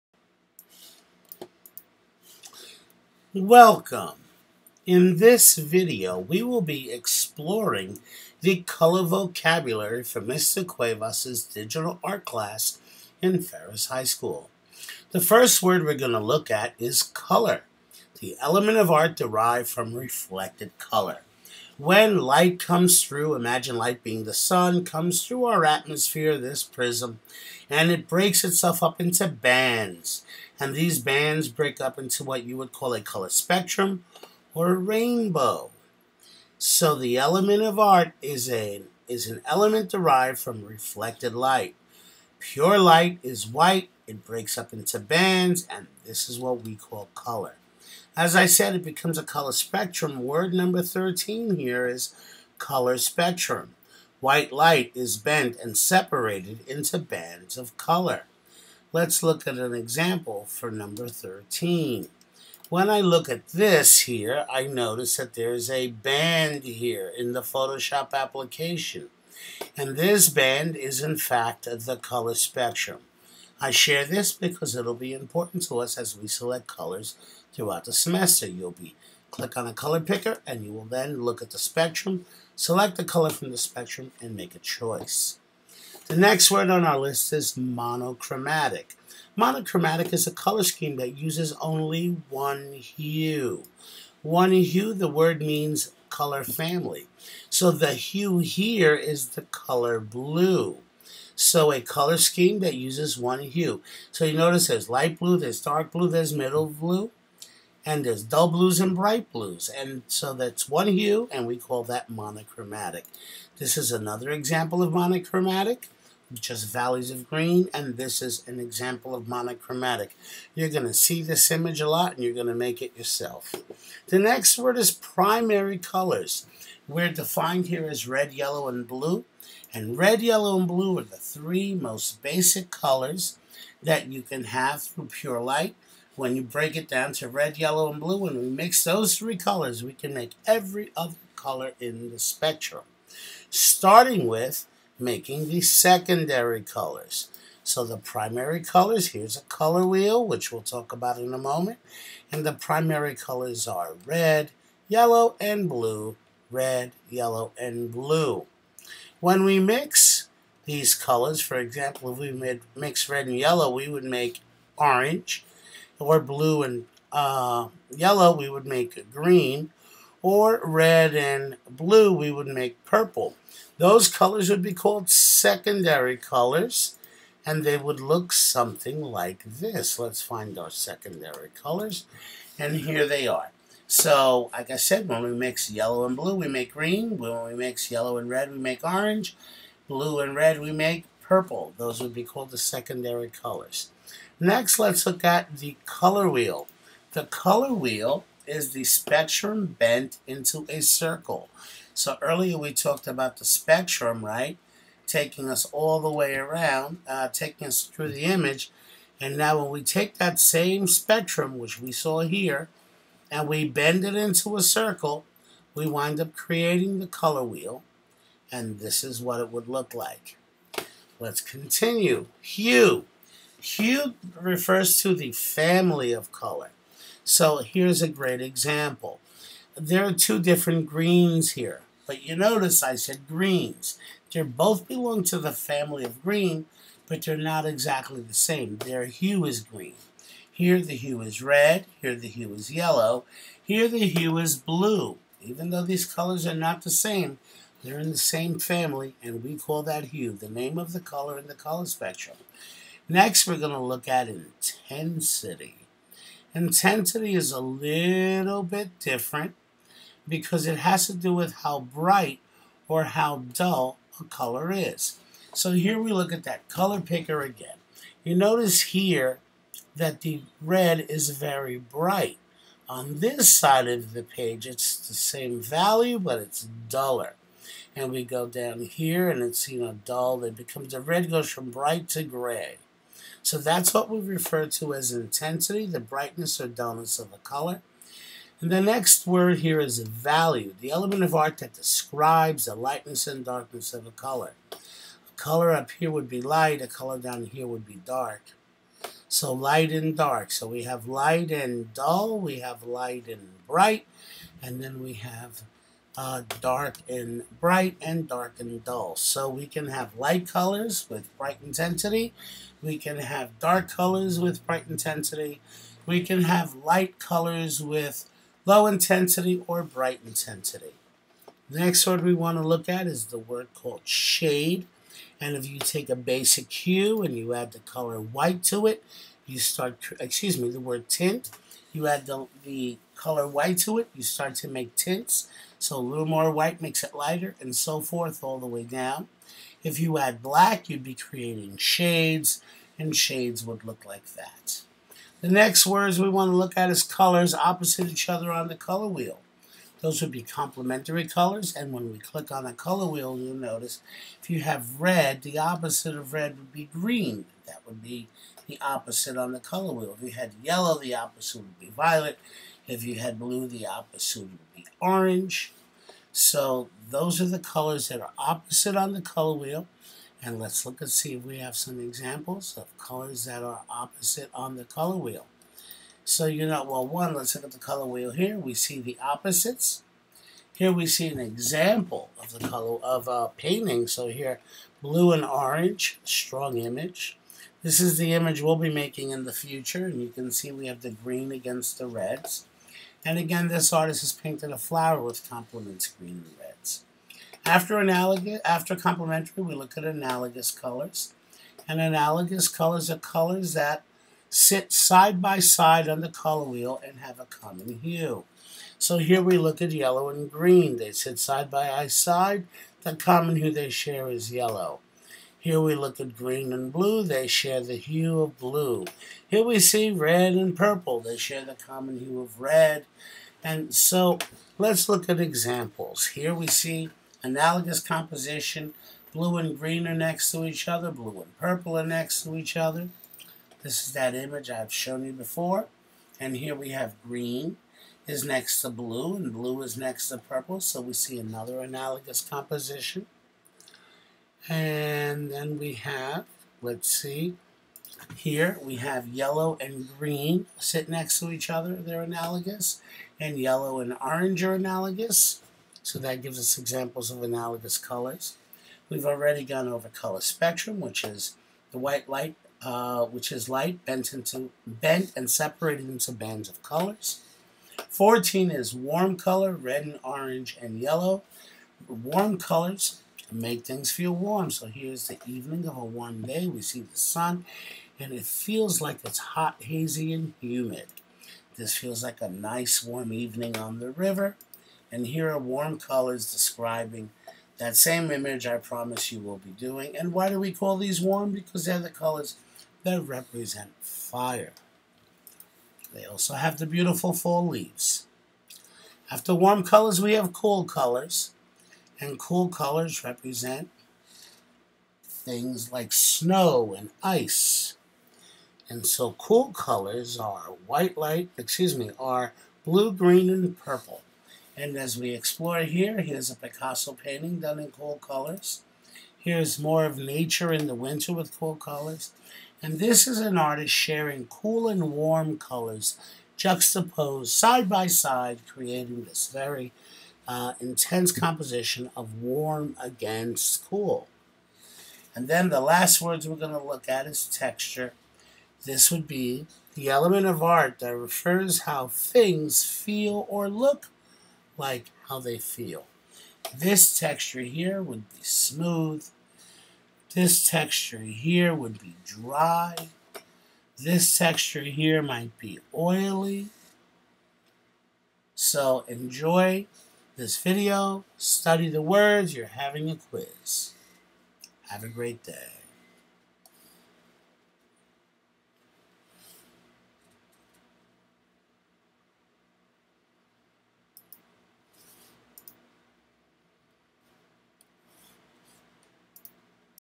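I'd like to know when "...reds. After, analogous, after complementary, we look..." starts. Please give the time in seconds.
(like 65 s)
396 s.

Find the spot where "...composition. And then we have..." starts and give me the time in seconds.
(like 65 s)
442 s.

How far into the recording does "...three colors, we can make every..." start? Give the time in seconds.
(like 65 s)
139 s.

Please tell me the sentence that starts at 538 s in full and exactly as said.
This would be the element of art that refers how things feel or look like how they feel.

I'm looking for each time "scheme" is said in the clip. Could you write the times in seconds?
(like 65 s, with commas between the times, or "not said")
90 s, 102 s.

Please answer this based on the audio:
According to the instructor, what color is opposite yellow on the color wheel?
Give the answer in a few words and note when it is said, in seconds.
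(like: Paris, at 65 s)
Violet, at 361 s.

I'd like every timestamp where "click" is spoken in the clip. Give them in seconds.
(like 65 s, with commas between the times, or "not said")
79 s, 352 s.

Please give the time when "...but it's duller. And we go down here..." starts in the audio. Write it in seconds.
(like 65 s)
276 s.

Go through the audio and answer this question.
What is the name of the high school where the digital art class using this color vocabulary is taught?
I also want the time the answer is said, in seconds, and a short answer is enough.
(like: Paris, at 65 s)
Ferris High School, at 13 s.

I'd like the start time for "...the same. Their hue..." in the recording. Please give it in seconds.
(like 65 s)
238 s.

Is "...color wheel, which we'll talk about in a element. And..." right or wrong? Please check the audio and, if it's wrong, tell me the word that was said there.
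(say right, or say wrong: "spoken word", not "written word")
wrong: "moment", not "element".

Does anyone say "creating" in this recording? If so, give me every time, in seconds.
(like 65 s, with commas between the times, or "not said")
216 s, 341 s, 528 s.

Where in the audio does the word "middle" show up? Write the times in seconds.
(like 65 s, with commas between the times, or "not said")
106 s.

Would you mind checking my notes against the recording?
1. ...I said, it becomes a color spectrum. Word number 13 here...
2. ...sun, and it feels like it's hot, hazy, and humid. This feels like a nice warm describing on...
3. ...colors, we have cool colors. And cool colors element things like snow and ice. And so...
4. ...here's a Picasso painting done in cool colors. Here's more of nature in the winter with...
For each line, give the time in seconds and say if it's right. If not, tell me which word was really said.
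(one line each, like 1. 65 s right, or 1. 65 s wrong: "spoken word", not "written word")
1. 48 s right
2. 477 s wrong: "evening", not "describing"
3. 499 s wrong: "represent", not "element"
4. 516 s right.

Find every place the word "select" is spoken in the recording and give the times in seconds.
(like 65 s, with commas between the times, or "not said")
76 s, 82 s.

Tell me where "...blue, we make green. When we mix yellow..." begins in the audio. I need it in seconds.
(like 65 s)
186 s.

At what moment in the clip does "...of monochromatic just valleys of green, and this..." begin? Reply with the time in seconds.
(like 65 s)
114 s.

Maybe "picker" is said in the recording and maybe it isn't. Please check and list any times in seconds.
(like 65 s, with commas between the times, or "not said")
79 s, 267 s.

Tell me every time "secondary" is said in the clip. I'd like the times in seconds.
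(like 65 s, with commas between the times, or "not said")
145 s, 175 s, 180 s, 192 s.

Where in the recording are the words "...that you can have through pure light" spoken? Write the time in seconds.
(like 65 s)
133 s.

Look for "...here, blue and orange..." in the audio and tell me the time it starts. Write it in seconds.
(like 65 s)
384 s.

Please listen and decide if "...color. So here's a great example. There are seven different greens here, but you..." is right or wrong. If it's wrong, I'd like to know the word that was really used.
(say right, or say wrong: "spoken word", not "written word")
wrong: "two", not "seven".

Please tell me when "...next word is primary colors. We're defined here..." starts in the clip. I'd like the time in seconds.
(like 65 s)
124 s.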